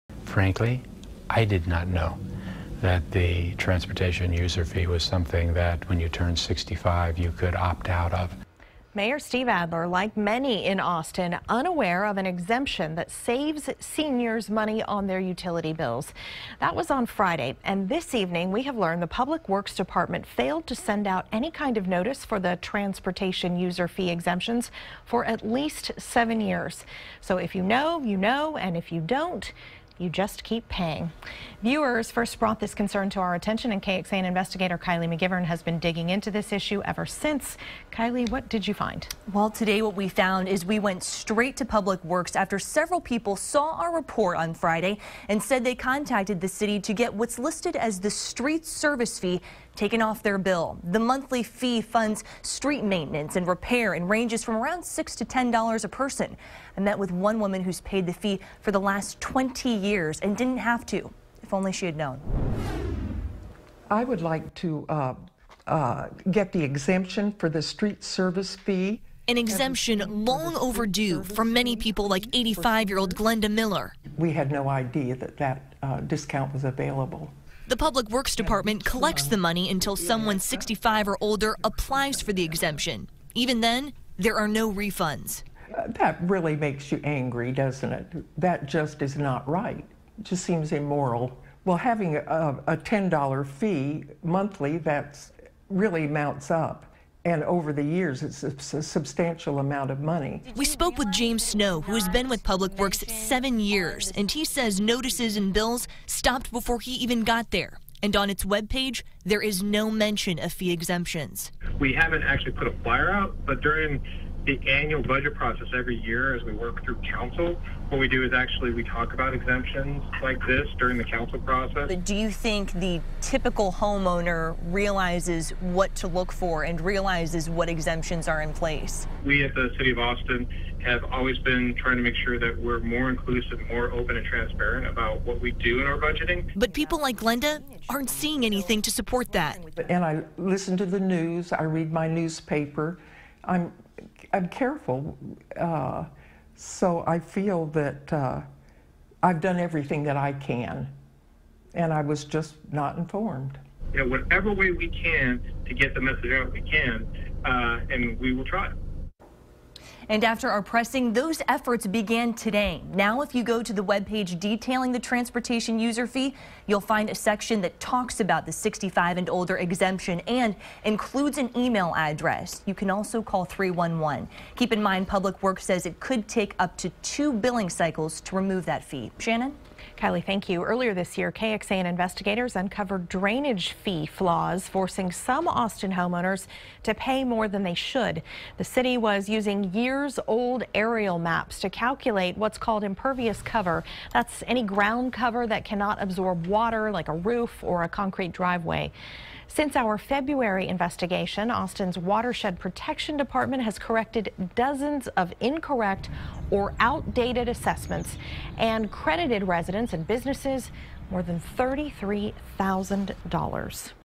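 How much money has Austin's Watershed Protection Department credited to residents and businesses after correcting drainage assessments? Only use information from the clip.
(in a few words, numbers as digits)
$33,000.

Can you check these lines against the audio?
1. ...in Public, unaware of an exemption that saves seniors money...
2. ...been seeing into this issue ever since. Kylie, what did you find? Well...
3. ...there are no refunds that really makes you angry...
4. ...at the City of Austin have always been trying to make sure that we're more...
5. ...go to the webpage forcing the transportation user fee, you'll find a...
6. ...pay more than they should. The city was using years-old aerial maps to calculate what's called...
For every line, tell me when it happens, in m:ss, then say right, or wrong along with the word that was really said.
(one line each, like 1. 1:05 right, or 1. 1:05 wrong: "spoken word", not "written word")
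1. 0:10 wrong: "Austin", not "Public"
2. 0:35 wrong: "digging", not "seeing"
3. 1:24 right
4. 2:09 right
5. 2:43 wrong: "detailing", not "forcing"
6. 3:06 right.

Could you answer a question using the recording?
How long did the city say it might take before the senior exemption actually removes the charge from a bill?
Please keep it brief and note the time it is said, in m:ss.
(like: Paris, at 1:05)
2 billing cycles, at 2:57.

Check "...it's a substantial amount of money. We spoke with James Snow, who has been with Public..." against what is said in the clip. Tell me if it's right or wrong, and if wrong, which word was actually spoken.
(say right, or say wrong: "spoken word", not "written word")
right.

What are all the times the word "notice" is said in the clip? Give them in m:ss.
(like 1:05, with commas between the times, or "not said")
0:21, 1:44.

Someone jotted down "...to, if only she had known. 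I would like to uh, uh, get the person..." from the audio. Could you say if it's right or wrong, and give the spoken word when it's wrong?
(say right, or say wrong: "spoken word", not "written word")
wrong: "exemption", not "person".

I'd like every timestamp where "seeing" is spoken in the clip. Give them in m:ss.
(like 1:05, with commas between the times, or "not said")
2:18.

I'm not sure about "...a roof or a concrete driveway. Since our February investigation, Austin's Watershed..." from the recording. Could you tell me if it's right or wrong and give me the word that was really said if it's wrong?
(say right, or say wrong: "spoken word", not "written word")
right.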